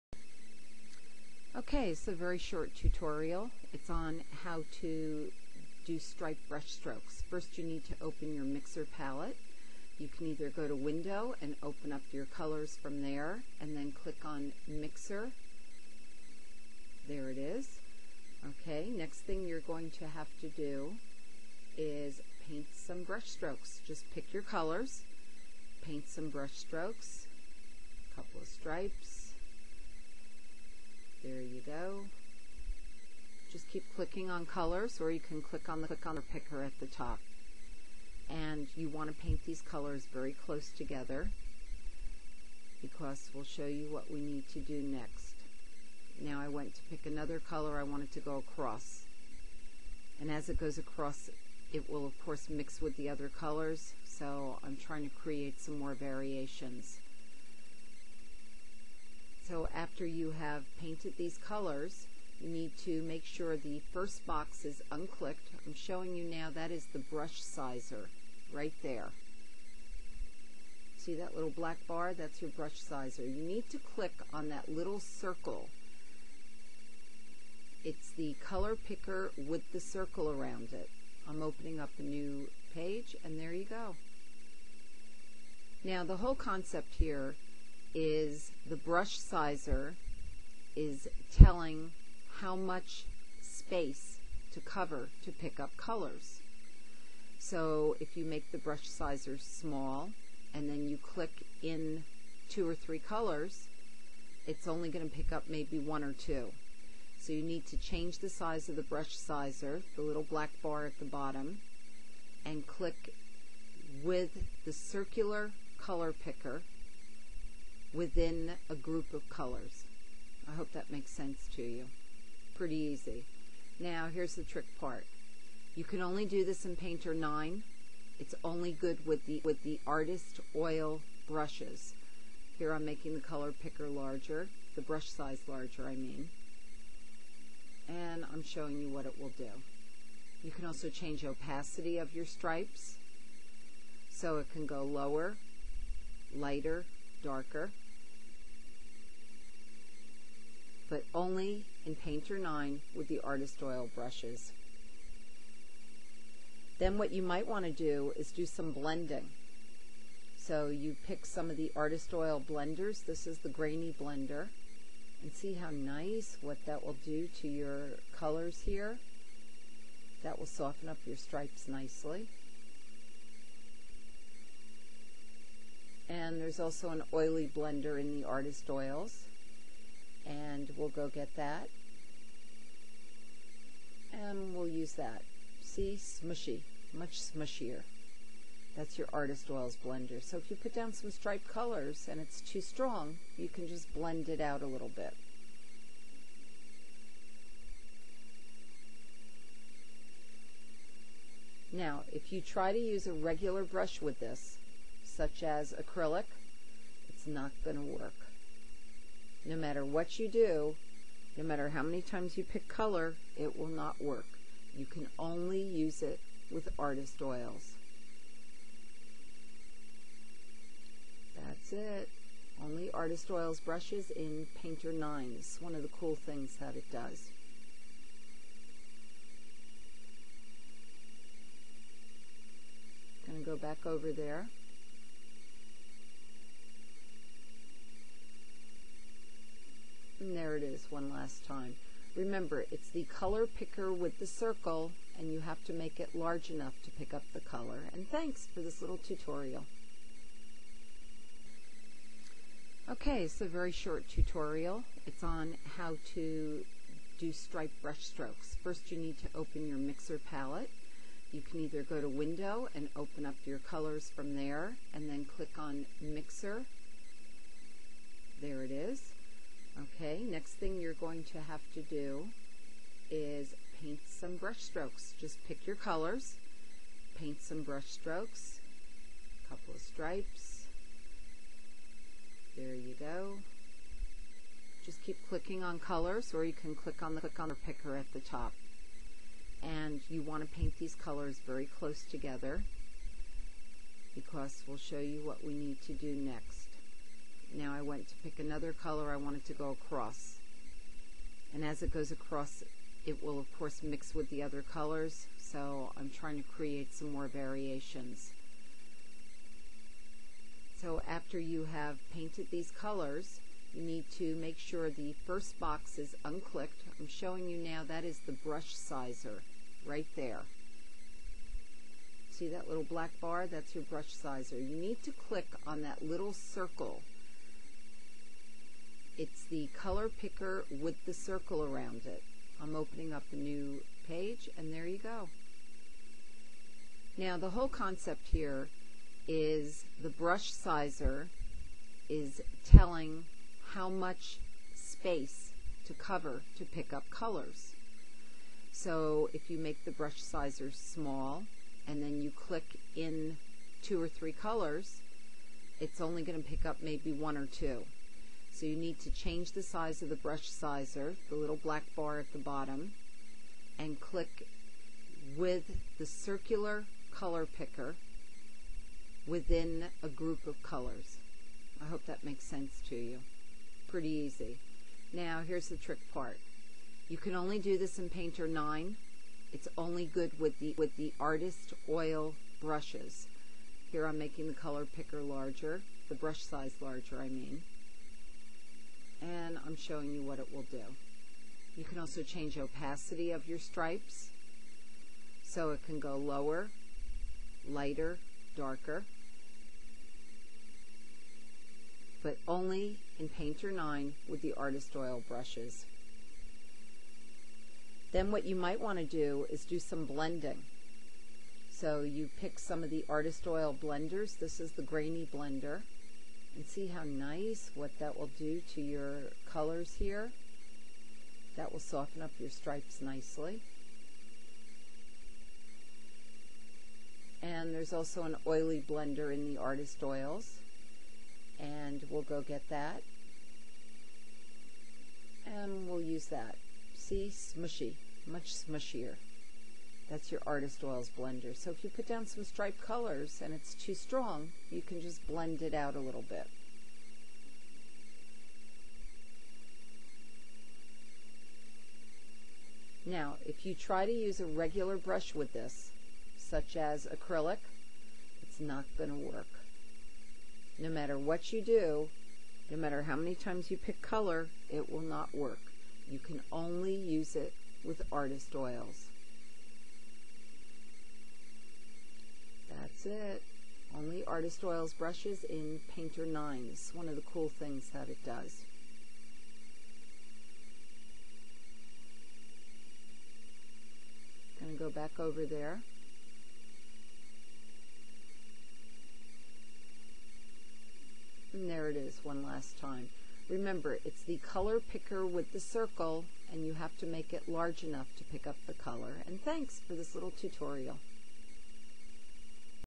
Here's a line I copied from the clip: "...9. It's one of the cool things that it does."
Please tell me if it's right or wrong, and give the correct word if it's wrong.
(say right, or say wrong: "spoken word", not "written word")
right.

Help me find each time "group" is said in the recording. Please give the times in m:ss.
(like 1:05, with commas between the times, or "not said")
1:58, 6:10.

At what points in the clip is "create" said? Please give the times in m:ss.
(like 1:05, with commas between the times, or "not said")
0:55, 5:06.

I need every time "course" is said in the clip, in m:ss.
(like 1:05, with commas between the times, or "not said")
0:52, 5:03.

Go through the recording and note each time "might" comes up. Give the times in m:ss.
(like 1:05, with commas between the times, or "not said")
2:37, 6:48.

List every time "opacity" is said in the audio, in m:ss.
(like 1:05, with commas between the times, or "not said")
2:21, 6:32.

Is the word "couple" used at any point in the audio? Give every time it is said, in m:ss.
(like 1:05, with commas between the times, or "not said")
0:28, 4:39.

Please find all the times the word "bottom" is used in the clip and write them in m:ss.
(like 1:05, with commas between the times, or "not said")
1:51, 6:02.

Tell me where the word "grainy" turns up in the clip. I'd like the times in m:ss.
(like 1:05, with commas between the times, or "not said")
2:43, 6:54.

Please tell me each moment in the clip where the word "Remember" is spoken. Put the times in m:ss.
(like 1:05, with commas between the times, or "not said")
4:02, 8:13.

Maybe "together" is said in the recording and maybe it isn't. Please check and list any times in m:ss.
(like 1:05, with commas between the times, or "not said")
0:40, 4:52.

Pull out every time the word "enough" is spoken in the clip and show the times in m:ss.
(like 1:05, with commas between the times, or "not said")
4:06, 8:17.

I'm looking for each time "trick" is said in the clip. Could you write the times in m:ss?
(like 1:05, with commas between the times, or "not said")
2:04, 6:15.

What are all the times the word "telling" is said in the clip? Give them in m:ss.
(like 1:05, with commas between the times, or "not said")
1:31, 5:42.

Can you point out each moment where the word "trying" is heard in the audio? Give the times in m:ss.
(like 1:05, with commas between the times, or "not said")
0:54, 5:06.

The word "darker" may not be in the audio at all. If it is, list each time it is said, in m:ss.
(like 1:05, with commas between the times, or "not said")
2:27, 6:38.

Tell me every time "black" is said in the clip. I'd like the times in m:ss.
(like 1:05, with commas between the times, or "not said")
1:11, 1:50, 5:22, 6:01.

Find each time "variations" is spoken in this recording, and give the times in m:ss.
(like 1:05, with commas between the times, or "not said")
0:55, 5:07.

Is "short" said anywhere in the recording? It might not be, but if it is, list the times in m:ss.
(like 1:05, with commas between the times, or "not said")
0:02, 4:13.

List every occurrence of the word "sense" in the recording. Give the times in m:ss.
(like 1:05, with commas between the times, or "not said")
2:01, 6:12.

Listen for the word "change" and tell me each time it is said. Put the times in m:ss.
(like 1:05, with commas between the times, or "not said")
1:47, 2:20, 5:59, 6:32.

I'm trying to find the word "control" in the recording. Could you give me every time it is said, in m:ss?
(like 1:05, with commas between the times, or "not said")
not said.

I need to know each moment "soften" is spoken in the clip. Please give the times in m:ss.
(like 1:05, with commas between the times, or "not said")
2:50, 7:01.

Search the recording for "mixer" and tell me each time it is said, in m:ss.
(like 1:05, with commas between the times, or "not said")
0:08, 0:14, 4:19, 4:26.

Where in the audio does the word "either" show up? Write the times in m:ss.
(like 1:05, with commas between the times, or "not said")
0:10, 4:21.